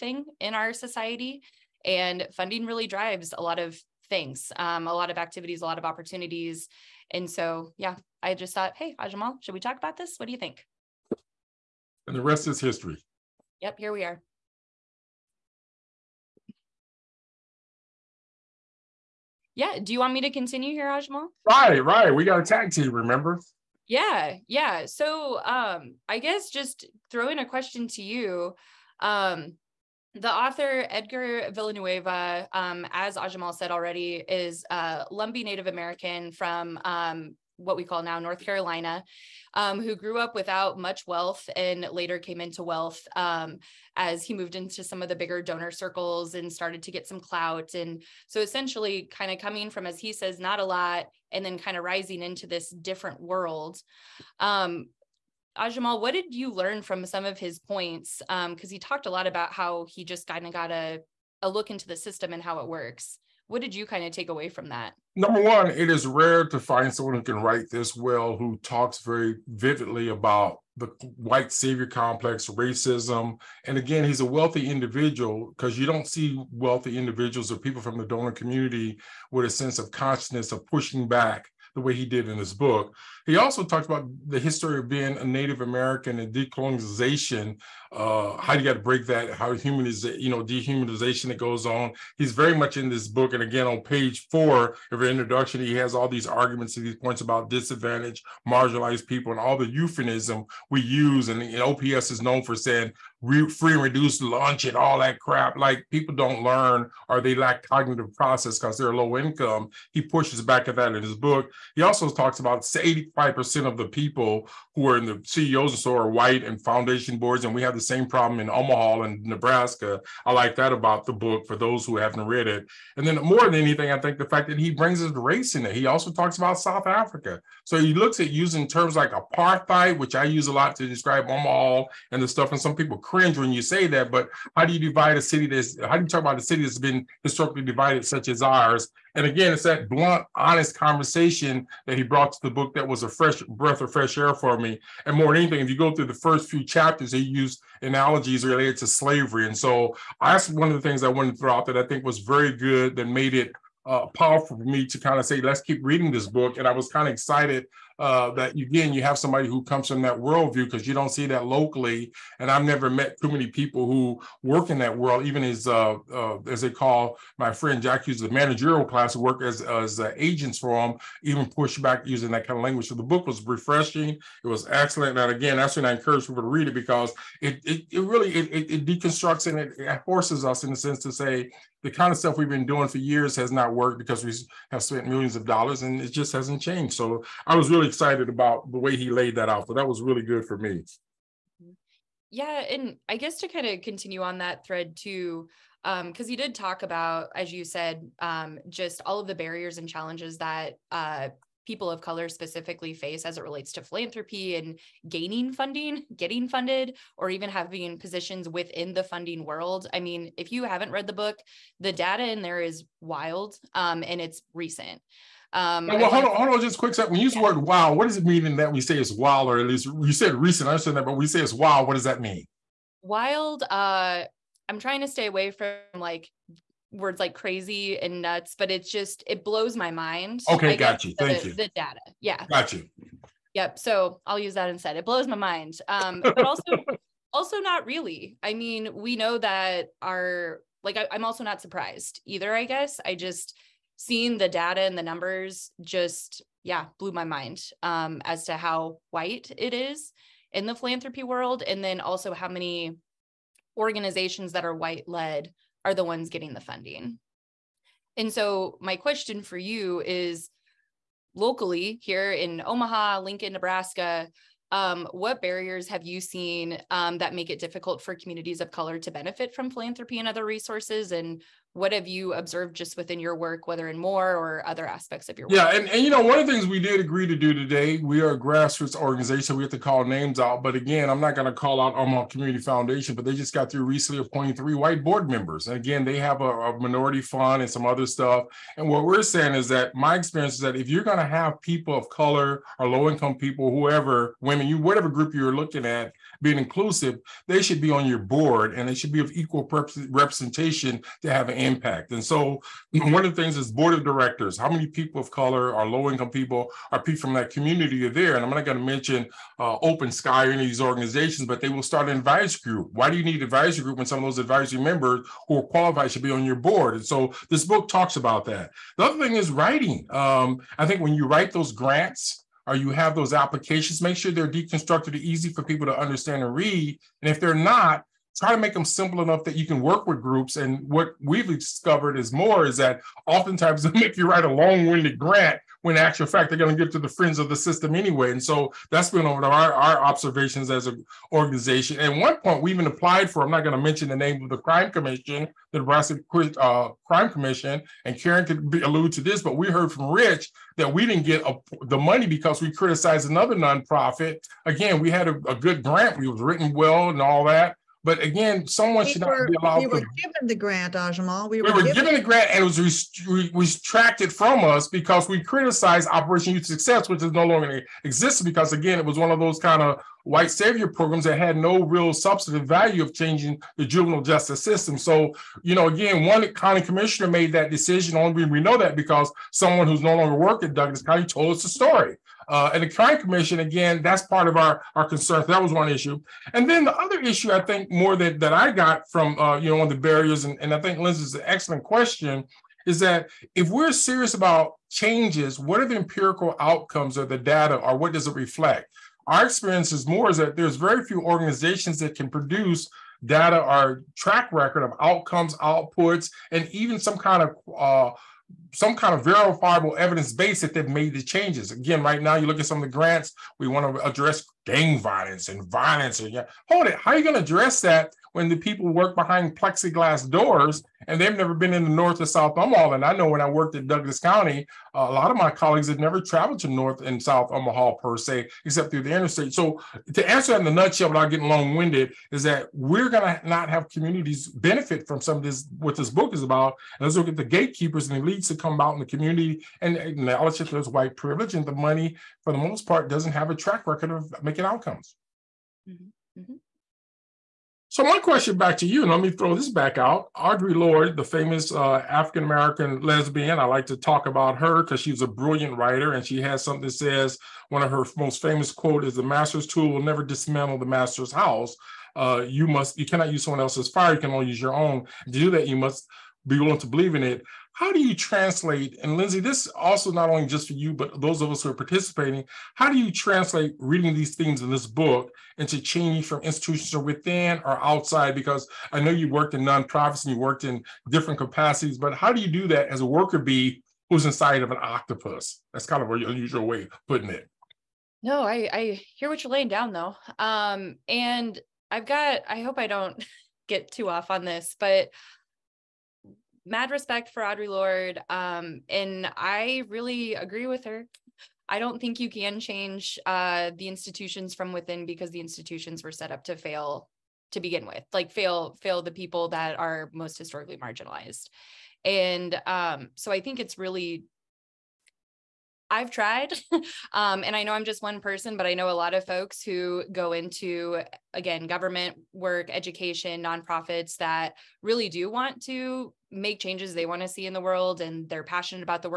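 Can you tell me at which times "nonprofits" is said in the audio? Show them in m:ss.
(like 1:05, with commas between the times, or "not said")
5:53, 7:59, 8:43.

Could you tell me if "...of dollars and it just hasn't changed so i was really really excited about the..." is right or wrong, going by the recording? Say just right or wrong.
right.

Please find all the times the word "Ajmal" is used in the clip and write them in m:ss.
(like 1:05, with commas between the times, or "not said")
0:20, 0:33.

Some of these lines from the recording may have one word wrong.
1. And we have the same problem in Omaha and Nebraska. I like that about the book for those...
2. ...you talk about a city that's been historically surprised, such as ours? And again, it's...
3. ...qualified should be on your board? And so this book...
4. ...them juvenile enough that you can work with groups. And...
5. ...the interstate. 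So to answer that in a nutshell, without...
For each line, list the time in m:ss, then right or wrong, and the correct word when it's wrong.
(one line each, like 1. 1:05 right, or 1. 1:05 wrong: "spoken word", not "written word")
1. 1:57 right
2. 2:16 wrong: "divided", not "surprised"
3. 5:15 right
4. 5:28 wrong: "simple", not "juvenile"
5. 7:09 right.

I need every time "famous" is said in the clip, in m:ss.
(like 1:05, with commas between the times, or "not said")
7:31, 7:38.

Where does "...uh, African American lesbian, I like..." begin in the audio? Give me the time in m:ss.
7:31.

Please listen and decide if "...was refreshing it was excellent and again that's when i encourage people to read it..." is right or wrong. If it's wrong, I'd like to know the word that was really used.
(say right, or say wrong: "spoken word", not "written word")
right.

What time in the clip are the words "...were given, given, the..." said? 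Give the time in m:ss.
6:01.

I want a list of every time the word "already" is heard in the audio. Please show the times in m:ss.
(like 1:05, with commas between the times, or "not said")
0:33.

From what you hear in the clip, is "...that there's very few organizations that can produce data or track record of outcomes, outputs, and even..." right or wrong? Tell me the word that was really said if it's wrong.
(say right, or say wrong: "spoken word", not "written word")
right.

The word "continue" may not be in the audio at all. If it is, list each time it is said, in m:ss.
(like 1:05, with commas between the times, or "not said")
0:20, 3:13.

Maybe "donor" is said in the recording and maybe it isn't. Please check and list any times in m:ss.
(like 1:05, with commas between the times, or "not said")
0:45, 1:18.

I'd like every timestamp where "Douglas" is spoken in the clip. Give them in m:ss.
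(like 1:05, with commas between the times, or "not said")
6:20, 7:03.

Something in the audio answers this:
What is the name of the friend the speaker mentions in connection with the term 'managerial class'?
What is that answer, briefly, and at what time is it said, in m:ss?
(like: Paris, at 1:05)
Jack Hughes, at 2:47.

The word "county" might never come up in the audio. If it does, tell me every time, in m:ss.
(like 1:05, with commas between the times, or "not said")
6:16, 6:21, 7:04.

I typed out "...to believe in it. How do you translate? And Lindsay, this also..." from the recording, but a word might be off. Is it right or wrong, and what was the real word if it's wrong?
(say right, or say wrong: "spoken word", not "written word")
right.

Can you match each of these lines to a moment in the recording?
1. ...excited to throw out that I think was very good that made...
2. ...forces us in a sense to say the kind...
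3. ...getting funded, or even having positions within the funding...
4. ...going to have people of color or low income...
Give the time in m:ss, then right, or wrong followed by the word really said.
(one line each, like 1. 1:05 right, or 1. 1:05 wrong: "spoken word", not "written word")
1. 2:31 wrong: "wanted", not "excited"
2. 3:00 right
3. 3:26 right
4. 4:51 right.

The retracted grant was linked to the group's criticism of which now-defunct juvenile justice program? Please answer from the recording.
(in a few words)
Operation Youth Success.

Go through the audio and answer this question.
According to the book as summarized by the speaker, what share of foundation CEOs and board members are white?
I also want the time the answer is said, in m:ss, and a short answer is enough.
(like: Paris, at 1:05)
85%, at 1:52.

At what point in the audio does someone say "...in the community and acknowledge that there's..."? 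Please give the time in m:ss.
7:18.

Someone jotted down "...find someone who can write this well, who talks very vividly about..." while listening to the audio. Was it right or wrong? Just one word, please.
right.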